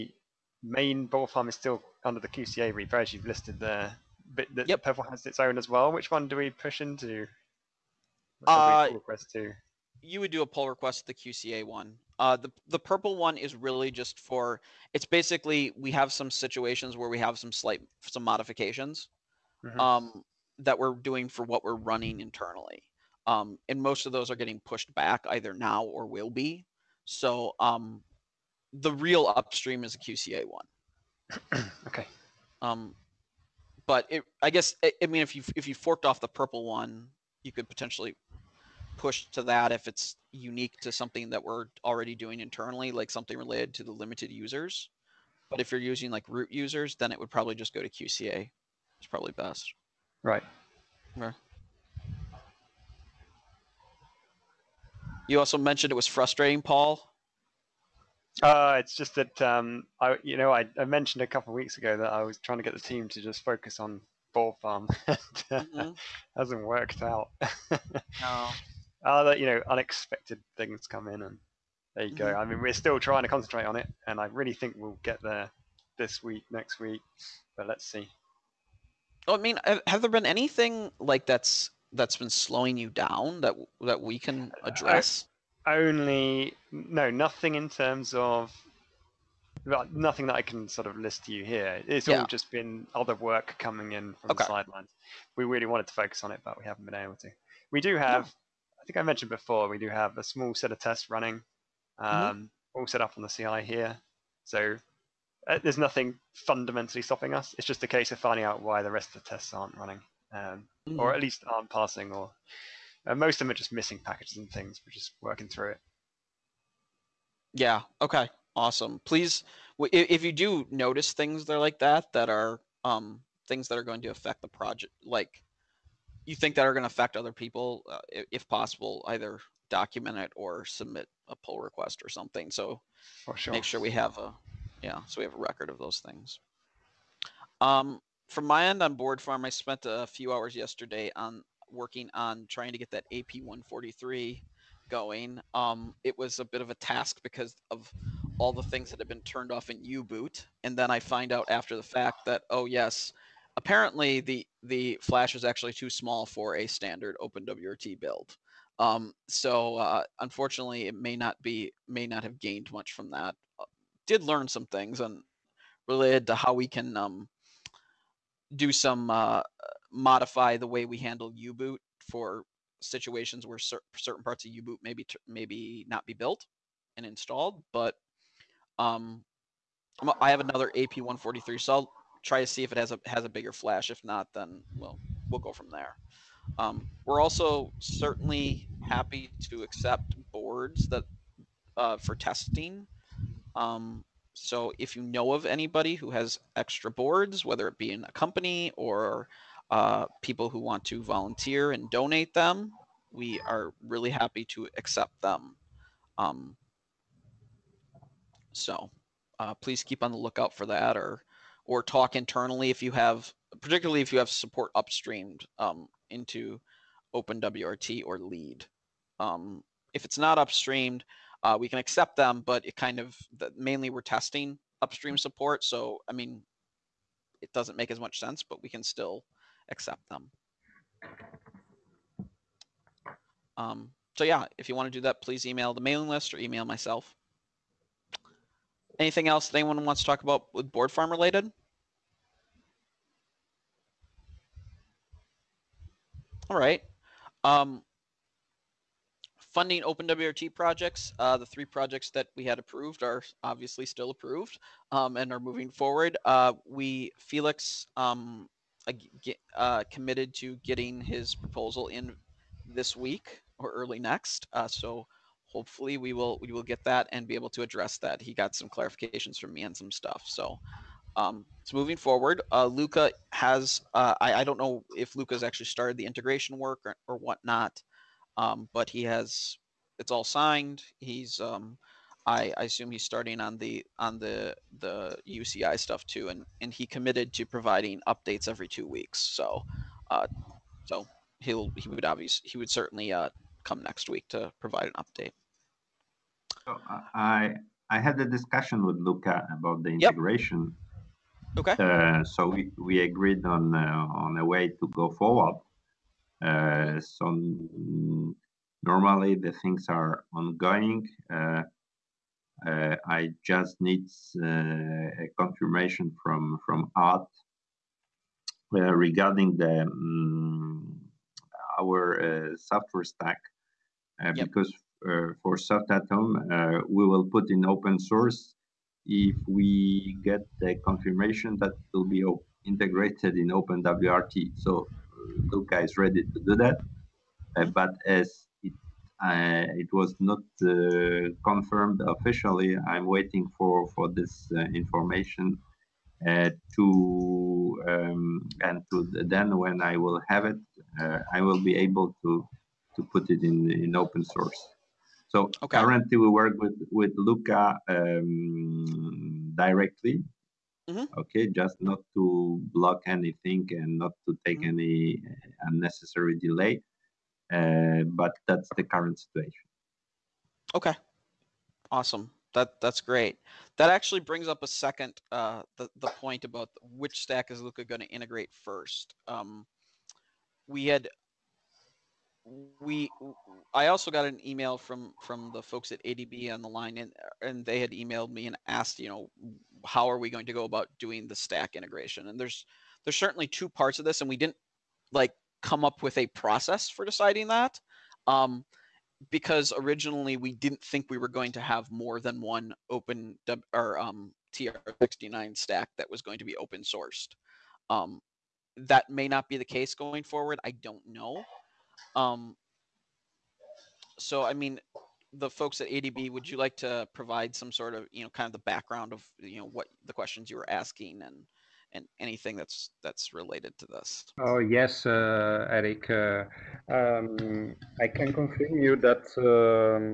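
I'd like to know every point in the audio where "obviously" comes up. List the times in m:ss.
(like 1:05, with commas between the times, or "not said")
4:13, 4:52.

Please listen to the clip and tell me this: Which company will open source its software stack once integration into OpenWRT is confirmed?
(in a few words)
SoftAtHome.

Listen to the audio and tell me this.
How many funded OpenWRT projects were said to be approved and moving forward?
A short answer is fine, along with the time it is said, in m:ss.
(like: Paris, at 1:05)
3, at 4:11.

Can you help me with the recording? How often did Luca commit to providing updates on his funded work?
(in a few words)
every 2 weeks.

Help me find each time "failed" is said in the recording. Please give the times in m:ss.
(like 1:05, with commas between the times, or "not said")
not said.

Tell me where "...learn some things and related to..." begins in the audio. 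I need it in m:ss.
2:44.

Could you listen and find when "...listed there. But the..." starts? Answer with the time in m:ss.
0:03.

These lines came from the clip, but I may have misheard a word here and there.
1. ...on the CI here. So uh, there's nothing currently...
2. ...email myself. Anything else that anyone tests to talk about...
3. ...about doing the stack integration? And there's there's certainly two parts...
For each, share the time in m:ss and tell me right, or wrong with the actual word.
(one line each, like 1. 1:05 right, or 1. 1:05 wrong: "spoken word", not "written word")
1. 1:43 wrong: "fundamentally", not "currently"
2. 3:56 wrong: "wants", not "tests"
3. 6:30 right.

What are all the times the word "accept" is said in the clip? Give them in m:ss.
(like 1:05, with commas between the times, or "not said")
3:09, 3:24, 3:41, 3:49.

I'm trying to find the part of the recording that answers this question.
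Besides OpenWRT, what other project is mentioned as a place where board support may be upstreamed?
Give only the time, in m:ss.
3:38.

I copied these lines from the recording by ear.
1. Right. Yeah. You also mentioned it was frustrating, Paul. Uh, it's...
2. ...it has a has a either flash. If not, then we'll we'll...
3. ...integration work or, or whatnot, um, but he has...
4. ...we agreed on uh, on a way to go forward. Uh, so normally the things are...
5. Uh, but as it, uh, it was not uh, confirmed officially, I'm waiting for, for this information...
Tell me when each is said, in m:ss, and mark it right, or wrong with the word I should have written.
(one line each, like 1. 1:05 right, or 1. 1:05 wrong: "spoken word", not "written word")
1. 0:50 right
2. 3:02 wrong: "bigger", not "either"
3. 4:36 right
4. 5:02 right
5. 5:37 right.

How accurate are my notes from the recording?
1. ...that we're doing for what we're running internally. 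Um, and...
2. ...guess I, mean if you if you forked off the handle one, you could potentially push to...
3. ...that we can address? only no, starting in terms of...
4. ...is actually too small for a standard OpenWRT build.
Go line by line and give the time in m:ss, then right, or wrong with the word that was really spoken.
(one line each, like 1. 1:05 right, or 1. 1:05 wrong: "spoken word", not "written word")
1. 0:20 right
2. 0:34 wrong: "purple", not "handle"
3. 1:23 wrong: "nothing", not "starting"
4. 2:35 right.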